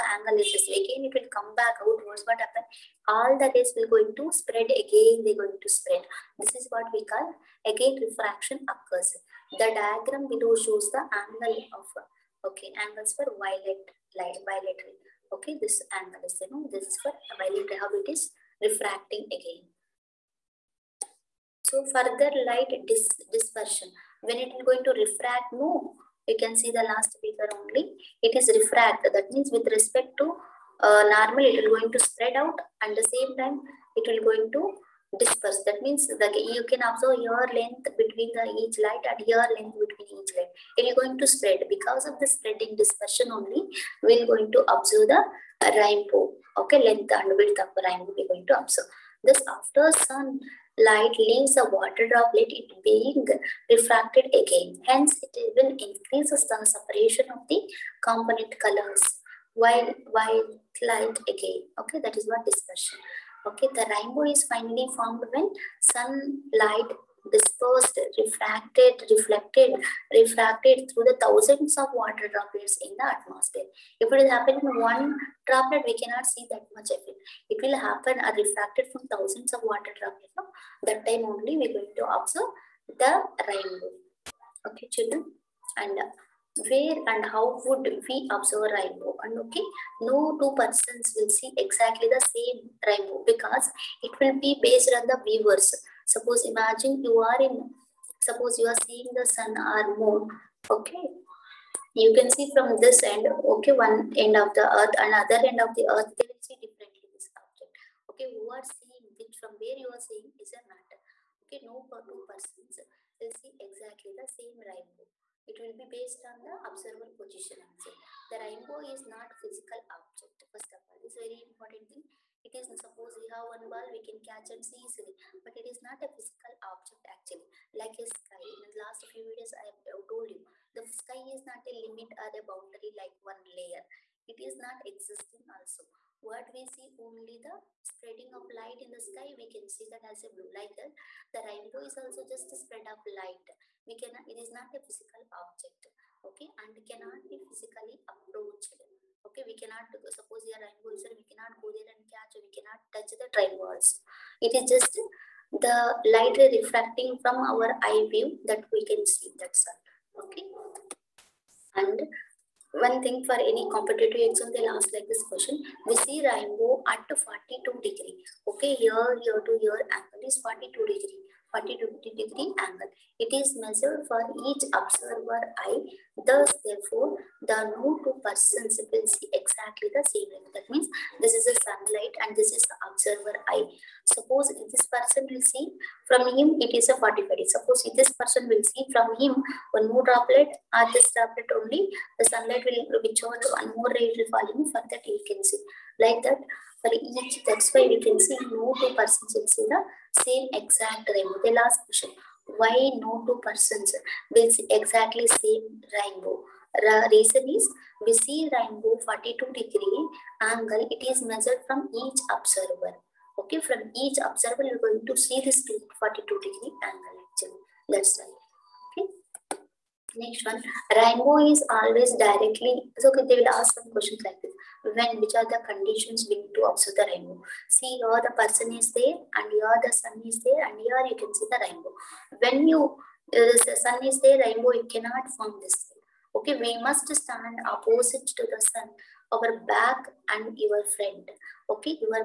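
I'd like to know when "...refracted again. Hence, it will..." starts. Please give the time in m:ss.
0:53.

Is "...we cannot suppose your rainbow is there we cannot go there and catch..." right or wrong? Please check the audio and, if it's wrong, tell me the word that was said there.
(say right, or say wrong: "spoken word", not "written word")
right.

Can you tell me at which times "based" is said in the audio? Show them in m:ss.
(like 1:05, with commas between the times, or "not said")
1:34, 1:55.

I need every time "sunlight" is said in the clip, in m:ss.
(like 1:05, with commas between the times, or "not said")
1:05, 3:01, 3:12.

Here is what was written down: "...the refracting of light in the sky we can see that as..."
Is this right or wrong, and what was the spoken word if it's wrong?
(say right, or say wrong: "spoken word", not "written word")
wrong: "spreading", not "refracting".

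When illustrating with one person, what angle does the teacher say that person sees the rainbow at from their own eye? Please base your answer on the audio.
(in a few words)
45 degrees.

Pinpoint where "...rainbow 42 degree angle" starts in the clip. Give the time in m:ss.
3:28.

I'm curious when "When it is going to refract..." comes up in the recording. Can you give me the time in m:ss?
0:24.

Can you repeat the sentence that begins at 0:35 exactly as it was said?
That means the, you can observe your length between the each light and your length between each light.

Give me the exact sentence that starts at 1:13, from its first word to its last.
If it is happening in one droplet, we cannot see that much effect.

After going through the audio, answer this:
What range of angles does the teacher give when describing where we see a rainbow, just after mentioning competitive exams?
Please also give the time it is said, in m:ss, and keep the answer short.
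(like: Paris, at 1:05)
40 to 50 degrees, at 2:51.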